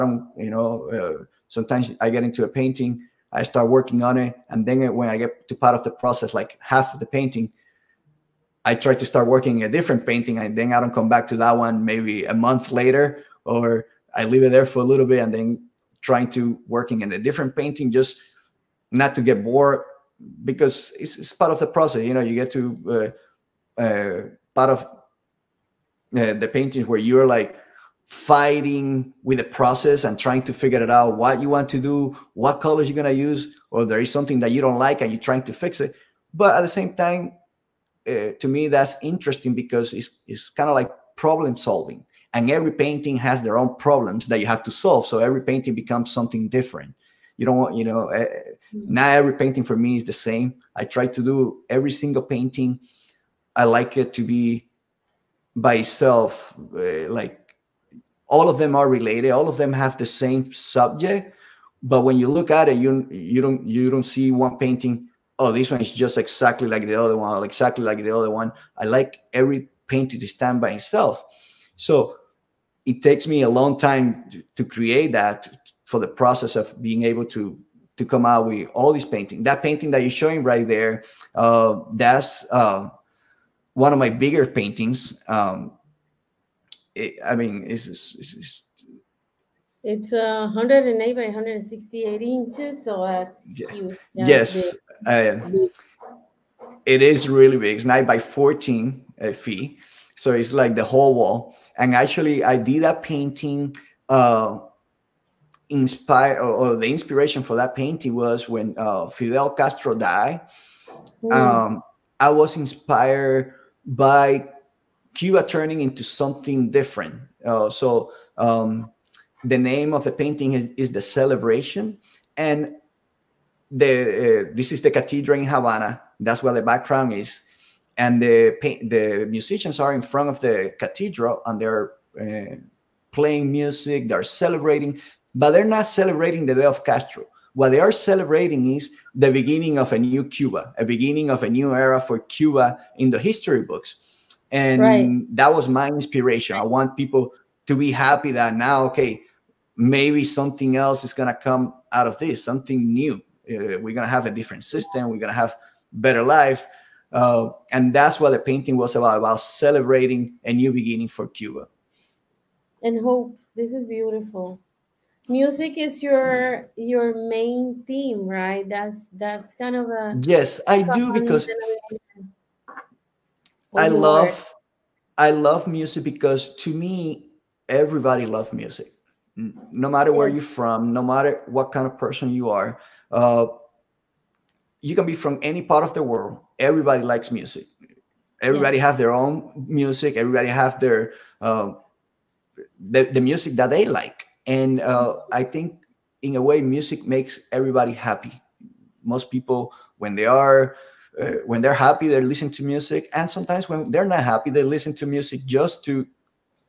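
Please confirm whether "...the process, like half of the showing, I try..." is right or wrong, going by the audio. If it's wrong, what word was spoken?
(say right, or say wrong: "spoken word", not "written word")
wrong: "painting", not "showing".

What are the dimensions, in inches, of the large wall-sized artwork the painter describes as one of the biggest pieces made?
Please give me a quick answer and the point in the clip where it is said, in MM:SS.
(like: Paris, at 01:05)
108 by 168 inches, at 01:30.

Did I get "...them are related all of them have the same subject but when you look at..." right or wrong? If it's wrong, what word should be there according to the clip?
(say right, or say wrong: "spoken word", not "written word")
right.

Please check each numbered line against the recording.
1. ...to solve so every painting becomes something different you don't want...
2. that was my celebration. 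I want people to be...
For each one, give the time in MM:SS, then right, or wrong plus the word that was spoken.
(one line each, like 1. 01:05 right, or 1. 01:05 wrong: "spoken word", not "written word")
1. 00:44 right
2. 02:25 wrong: "inspiration", not "celebration".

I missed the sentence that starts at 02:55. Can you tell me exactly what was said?
I love music because to me everybody loves music, no matter where yeah.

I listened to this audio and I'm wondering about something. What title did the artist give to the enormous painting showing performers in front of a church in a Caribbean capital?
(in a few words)
The Celebration.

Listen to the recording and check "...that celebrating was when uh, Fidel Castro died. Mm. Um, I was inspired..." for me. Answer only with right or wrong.
wrong.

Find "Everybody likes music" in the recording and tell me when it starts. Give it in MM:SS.
03:06.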